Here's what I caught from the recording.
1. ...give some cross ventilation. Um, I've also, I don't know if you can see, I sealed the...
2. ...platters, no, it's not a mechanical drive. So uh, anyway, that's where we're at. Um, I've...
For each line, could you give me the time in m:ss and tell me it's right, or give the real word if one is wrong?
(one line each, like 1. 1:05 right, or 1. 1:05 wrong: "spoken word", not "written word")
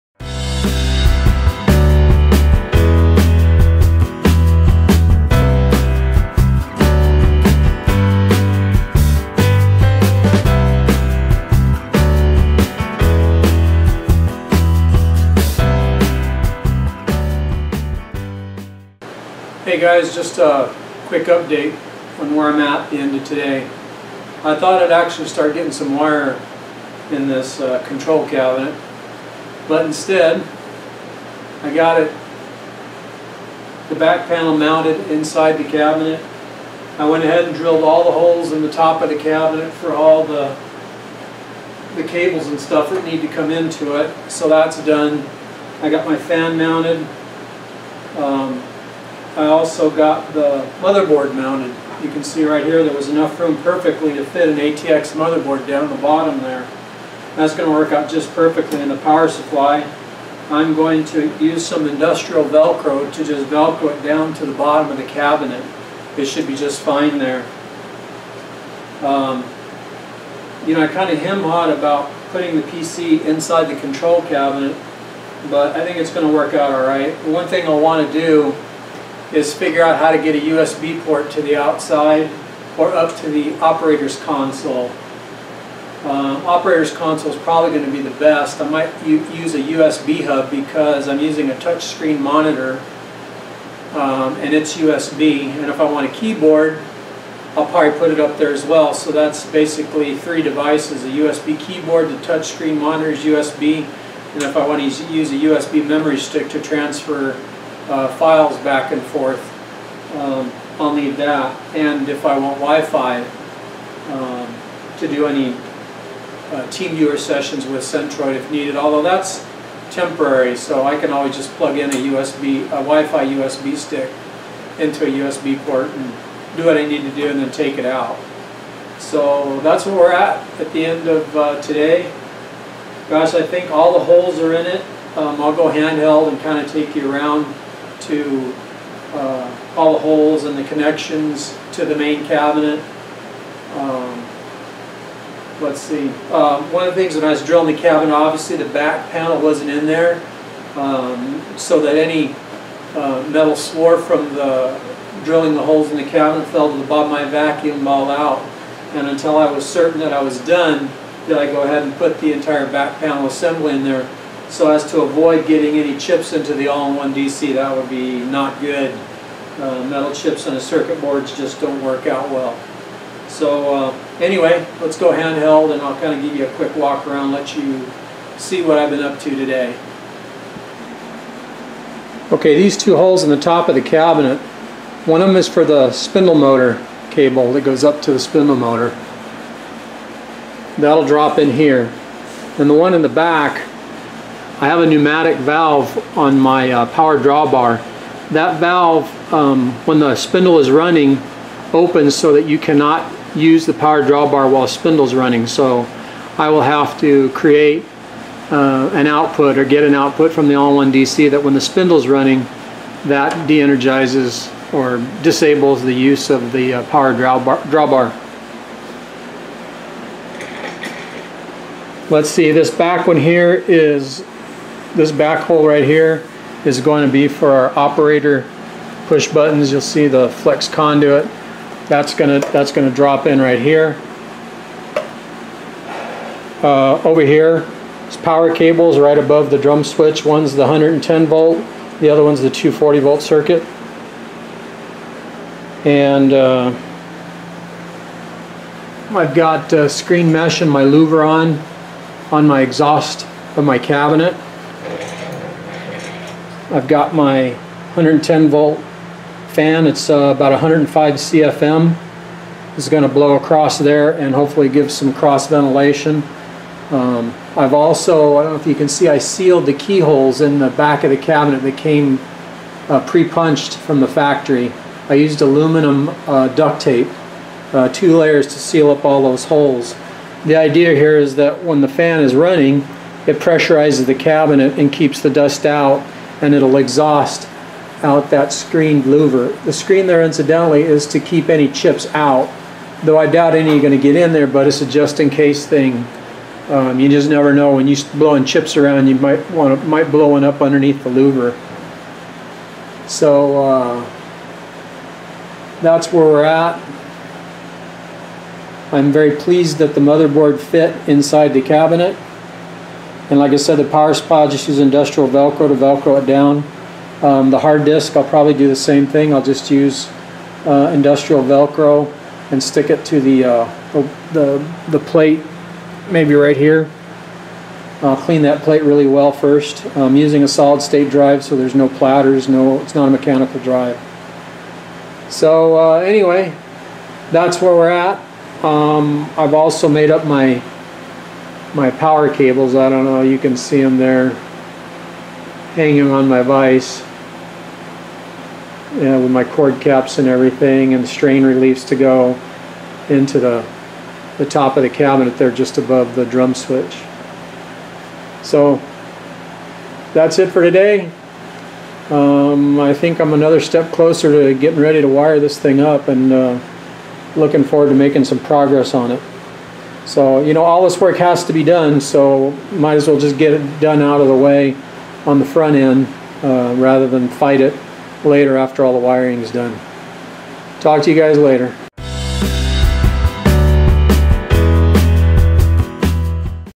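1. 4:24 right
2. 5:31 right.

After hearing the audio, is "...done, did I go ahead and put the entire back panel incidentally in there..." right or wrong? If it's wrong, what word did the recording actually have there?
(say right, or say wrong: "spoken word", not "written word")
wrong: "assembly", not "incidentally".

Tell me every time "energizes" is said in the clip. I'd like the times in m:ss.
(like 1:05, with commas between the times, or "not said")
3:33.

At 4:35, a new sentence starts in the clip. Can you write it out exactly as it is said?
I used aluminum uh, duct tape, uh, two layers to seal up all those holes.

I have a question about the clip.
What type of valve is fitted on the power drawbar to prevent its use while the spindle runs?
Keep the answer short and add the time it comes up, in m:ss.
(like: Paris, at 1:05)
pneumatic, at 3:14.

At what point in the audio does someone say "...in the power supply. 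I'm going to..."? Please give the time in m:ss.
0:58.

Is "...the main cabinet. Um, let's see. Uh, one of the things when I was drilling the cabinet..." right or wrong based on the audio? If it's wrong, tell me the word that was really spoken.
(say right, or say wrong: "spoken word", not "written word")
right.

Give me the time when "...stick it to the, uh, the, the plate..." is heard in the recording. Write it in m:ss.
5:22.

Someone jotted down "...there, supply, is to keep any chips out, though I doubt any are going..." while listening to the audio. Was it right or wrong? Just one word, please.
wrong.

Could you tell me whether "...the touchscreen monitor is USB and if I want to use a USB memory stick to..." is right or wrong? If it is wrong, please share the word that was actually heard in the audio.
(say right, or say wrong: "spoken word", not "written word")
right.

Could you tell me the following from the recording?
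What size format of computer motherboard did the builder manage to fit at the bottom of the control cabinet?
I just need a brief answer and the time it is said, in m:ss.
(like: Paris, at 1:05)
ATX, at 0:54.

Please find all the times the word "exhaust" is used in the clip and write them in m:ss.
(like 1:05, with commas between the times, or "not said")
4:12, 4:46.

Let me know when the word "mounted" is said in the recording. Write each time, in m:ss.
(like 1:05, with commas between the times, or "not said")
0:34, 0:46, 0:51.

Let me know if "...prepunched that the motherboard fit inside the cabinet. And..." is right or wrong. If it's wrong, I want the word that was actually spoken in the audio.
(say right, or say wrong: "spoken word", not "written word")
wrong: "pleased", not "prepunched".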